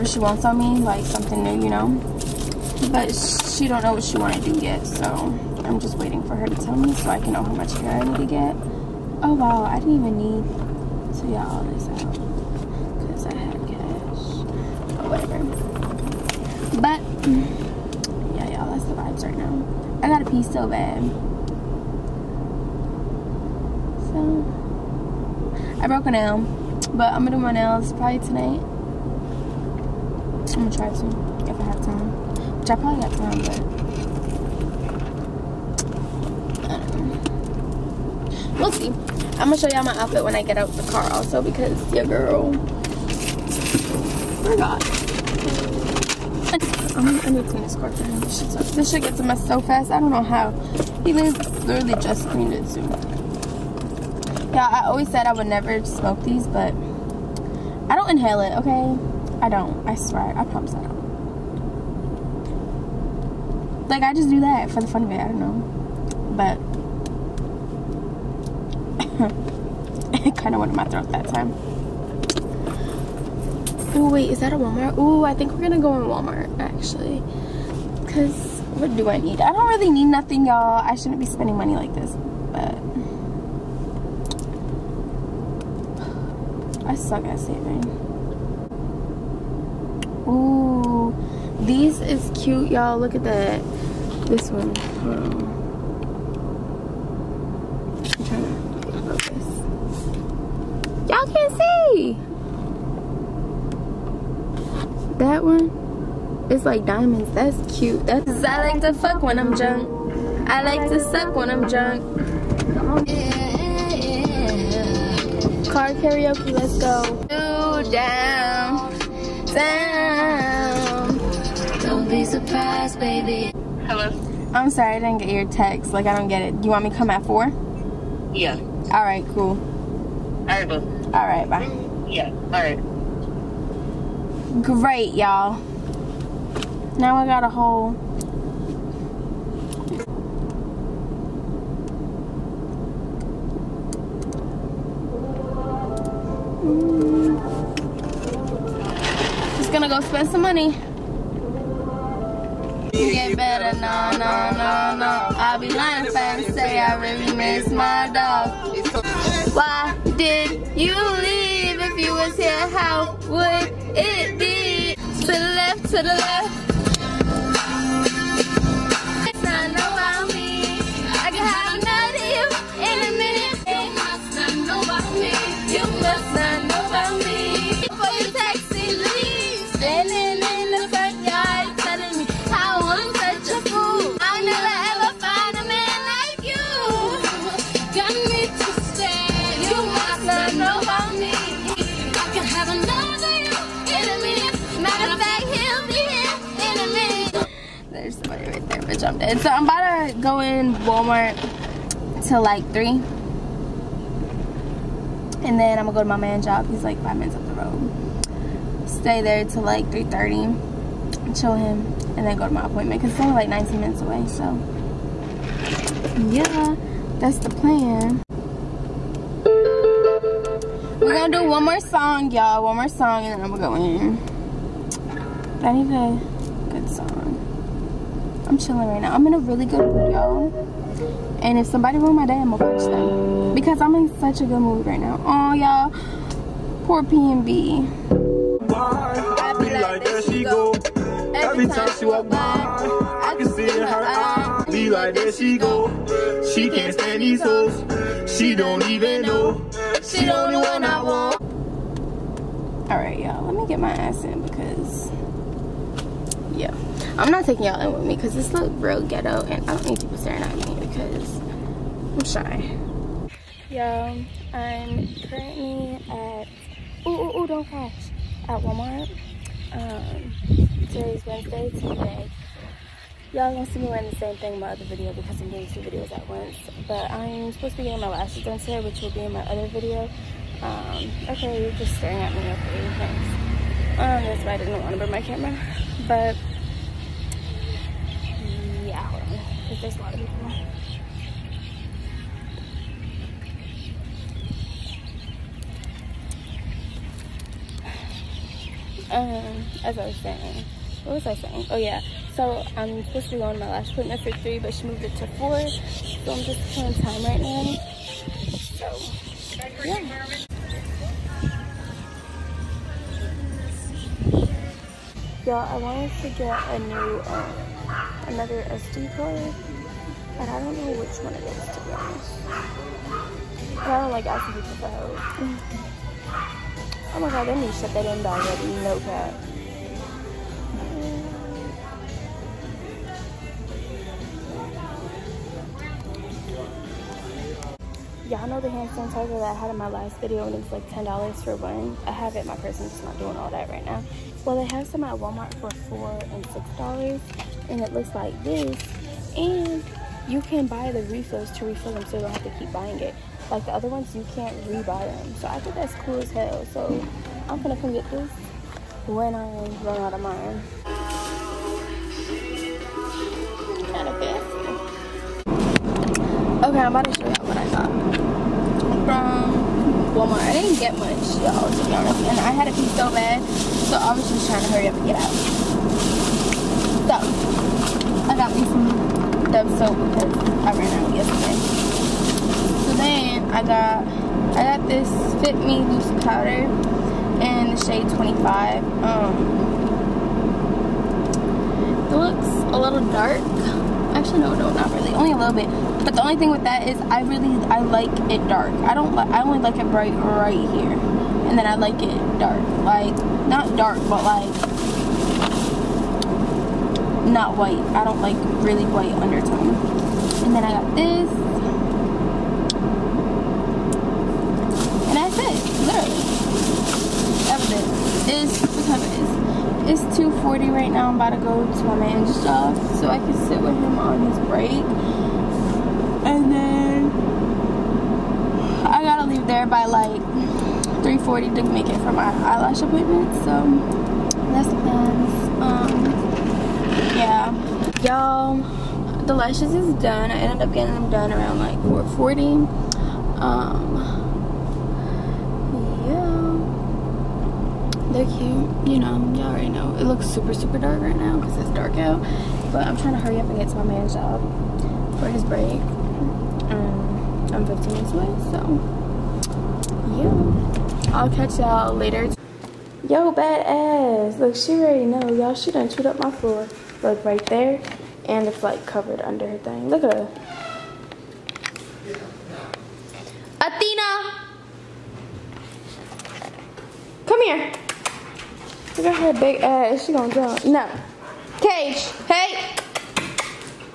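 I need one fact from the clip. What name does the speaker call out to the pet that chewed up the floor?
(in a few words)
Athena.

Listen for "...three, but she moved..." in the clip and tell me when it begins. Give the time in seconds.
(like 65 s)
304 s.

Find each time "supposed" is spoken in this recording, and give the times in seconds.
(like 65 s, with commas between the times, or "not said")
277 s, 303 s.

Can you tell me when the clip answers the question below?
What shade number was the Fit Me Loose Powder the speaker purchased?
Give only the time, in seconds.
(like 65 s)
388 s.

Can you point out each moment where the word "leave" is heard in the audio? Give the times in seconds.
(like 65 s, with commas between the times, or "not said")
161 s, 429 s.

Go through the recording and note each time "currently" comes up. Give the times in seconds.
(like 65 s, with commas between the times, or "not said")
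265 s.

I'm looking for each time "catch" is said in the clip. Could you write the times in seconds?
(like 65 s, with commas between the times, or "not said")
461 s.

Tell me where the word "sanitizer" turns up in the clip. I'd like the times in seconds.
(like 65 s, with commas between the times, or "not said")
338 s.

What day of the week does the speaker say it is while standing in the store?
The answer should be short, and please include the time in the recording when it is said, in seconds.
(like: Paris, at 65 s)
Wednesday, at 271 s.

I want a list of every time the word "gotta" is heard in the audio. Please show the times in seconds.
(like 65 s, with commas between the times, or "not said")
429 s.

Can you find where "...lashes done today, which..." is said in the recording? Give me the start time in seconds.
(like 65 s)
278 s.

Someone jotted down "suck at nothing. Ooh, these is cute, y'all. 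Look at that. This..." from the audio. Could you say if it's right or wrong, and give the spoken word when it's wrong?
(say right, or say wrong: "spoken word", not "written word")
wrong: "saving", not "nothing".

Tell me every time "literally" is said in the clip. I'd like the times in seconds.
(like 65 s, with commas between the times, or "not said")
51 s, 415 s.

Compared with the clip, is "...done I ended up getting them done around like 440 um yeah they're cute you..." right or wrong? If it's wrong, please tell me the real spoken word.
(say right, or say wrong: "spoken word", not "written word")
right.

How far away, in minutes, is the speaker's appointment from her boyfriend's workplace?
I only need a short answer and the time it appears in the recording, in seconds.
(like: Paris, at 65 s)
19 minutes, at 213 s.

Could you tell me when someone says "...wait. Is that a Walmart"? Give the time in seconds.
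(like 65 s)
74 s.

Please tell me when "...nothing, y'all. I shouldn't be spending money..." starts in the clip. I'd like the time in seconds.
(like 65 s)
80 s.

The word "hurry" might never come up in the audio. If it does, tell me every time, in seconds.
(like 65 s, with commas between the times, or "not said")
374 s, 453 s.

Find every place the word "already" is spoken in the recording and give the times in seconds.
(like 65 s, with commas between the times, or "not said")
449 s, 464 s.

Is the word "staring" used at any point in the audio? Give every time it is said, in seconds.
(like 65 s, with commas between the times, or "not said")
260 s, 281 s.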